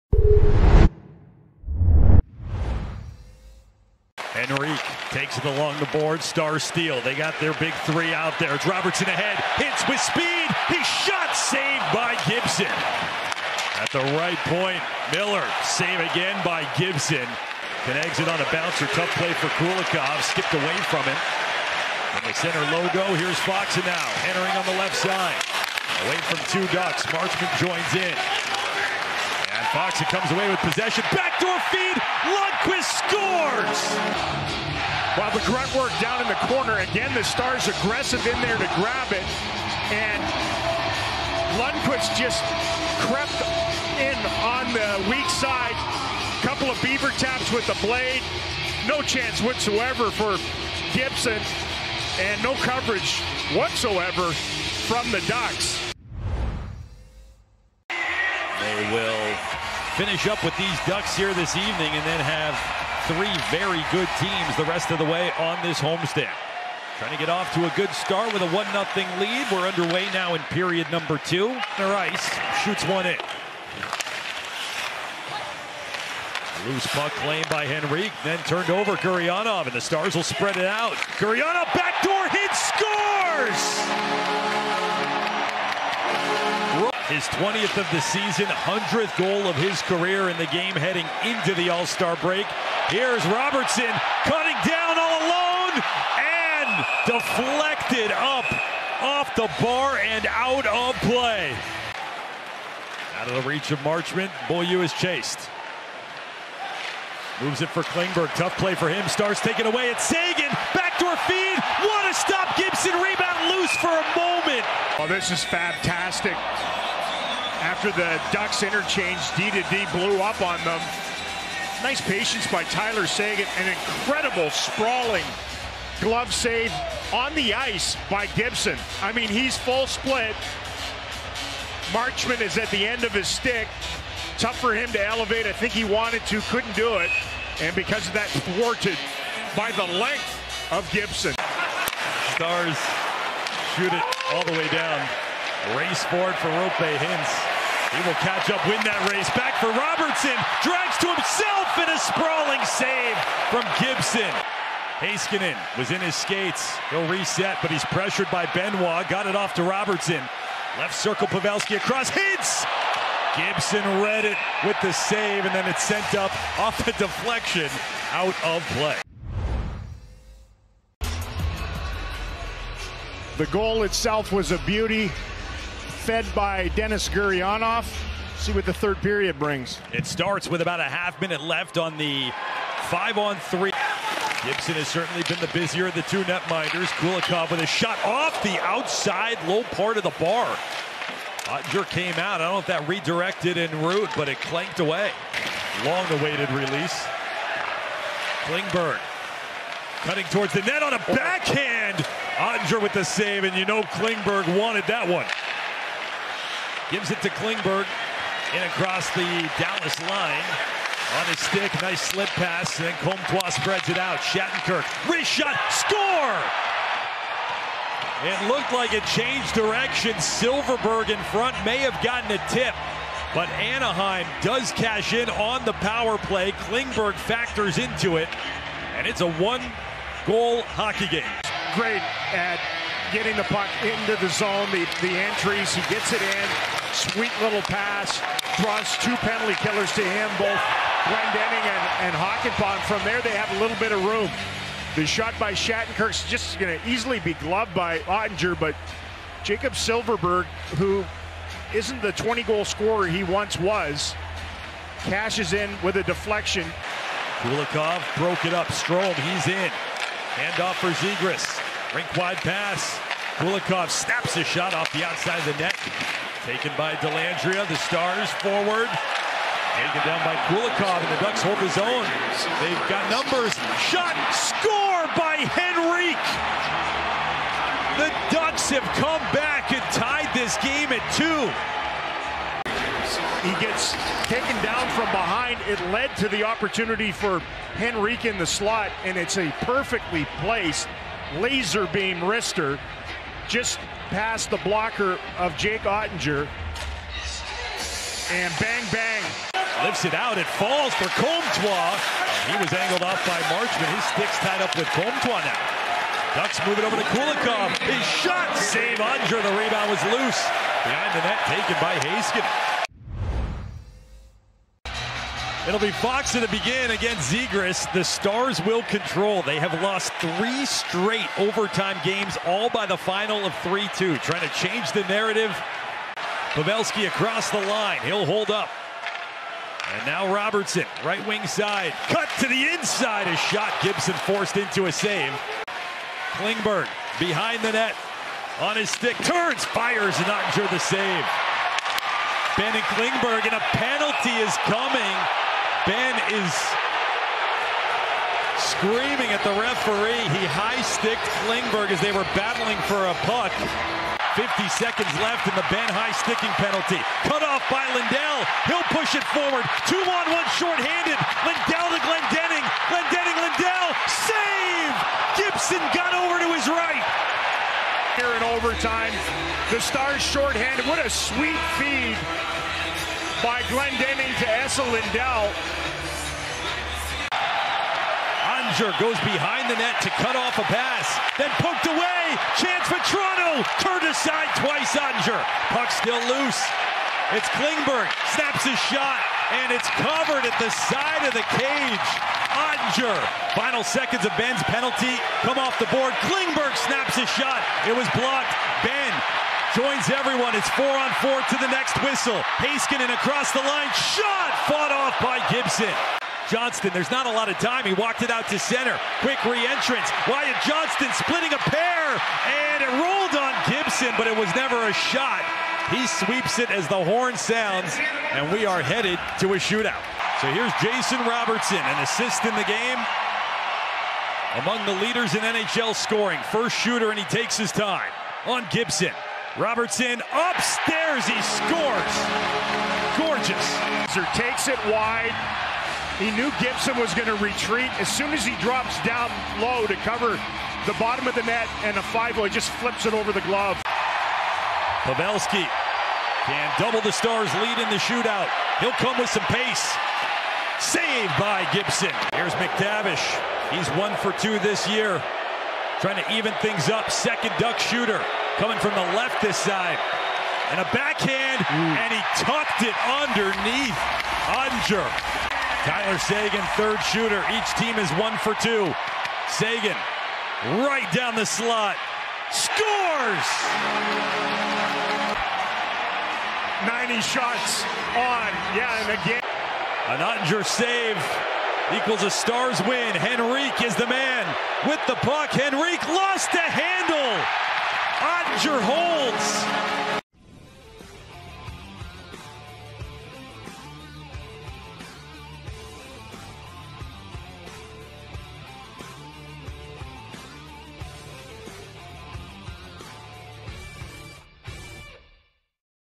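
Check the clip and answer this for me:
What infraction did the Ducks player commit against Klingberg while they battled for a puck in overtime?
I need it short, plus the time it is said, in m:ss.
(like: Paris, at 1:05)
High-sticking, at 5:50.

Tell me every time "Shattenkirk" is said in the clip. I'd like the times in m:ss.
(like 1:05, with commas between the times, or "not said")
3:34, 4:05.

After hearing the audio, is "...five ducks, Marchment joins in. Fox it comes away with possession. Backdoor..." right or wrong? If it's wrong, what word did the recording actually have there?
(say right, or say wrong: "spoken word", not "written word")
wrong: "two", not "five".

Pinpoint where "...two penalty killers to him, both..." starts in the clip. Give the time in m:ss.
3:58.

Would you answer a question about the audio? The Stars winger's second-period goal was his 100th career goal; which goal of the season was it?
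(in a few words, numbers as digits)
20th.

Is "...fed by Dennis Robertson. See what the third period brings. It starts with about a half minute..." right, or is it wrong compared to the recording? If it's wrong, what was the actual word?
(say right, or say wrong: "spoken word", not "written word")
wrong: "Gurianov", not "Robertson".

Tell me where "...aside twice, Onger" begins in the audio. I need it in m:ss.
6:24.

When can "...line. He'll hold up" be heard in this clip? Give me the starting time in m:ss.
5:27.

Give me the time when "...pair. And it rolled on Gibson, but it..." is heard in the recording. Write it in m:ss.
6:51.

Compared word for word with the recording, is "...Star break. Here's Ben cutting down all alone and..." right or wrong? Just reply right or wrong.
wrong.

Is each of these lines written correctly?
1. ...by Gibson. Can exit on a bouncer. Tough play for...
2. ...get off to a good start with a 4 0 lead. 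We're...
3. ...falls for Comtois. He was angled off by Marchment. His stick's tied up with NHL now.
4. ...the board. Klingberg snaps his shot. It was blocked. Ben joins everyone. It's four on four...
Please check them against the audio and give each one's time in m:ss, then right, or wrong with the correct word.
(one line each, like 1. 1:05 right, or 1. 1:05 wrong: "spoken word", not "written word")
1. 0:16 right
2. 1:07 wrong: "1", not "4"
3. 5:00 wrong: "Comtois", not "NHL"
4. 6:35 right.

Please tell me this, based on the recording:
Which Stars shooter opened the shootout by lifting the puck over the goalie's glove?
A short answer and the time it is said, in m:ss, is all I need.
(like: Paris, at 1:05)
Jason Robertson, at 7:00.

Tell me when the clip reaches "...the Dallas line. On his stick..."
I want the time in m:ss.
3:29.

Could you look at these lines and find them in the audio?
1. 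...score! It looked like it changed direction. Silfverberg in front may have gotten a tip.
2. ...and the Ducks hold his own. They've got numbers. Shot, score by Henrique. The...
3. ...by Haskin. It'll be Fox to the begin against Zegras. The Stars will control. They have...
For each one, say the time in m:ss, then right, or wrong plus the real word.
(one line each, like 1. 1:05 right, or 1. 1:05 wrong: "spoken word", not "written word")
1. 3:35 right
2. 4:30 right
3. 5:11 right.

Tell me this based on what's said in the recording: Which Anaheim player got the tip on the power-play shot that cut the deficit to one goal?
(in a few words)
Jacob Silfverberg.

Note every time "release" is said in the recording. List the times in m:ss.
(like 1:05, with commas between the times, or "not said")
3:16.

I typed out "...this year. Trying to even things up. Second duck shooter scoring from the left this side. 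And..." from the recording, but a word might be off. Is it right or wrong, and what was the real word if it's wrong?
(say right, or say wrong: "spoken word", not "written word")
wrong: "coming", not "scoring".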